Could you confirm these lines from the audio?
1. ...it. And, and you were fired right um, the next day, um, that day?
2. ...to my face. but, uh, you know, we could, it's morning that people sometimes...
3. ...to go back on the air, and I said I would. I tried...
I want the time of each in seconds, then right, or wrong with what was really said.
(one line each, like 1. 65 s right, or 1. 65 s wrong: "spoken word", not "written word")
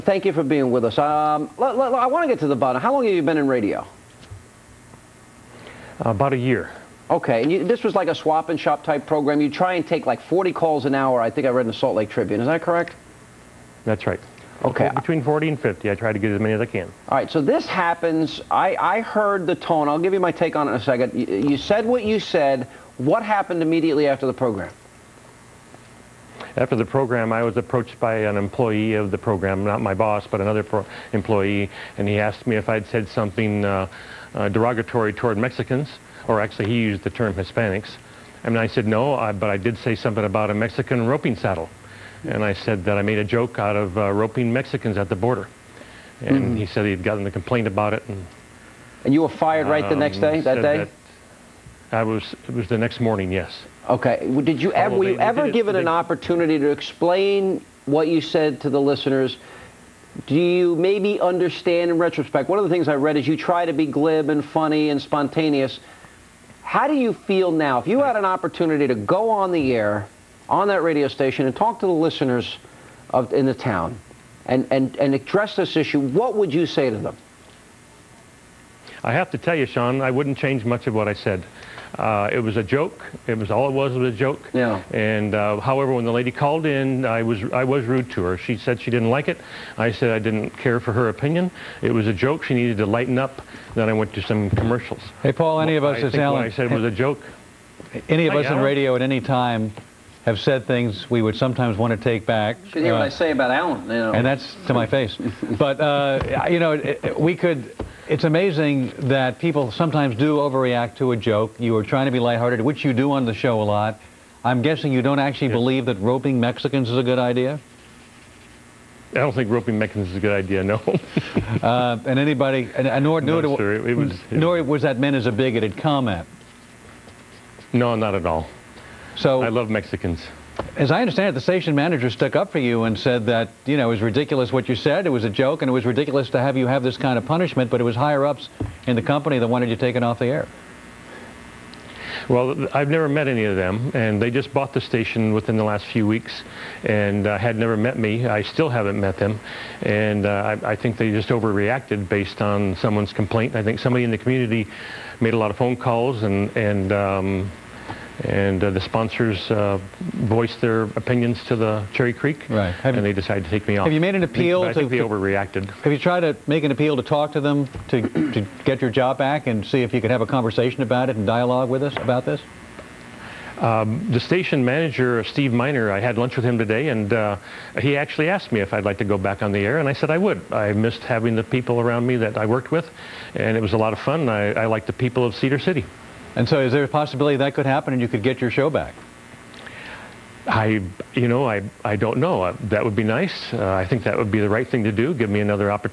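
1. 47 s right
2. 104 s wrong: "amazing", not "morning"
3. 178 s wrong: "missed", not "tried".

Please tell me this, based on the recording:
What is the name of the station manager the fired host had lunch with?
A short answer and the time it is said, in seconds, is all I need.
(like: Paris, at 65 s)
Steve Miner, at 175 s.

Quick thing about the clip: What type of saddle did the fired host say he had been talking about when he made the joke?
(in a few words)
Mexican roping saddle.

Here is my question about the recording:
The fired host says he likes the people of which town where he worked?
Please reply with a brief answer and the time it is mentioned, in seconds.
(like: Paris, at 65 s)
Cedar City, at 185 s.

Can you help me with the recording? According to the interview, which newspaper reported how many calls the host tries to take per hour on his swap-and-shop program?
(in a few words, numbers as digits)
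Salt Lake Tribune.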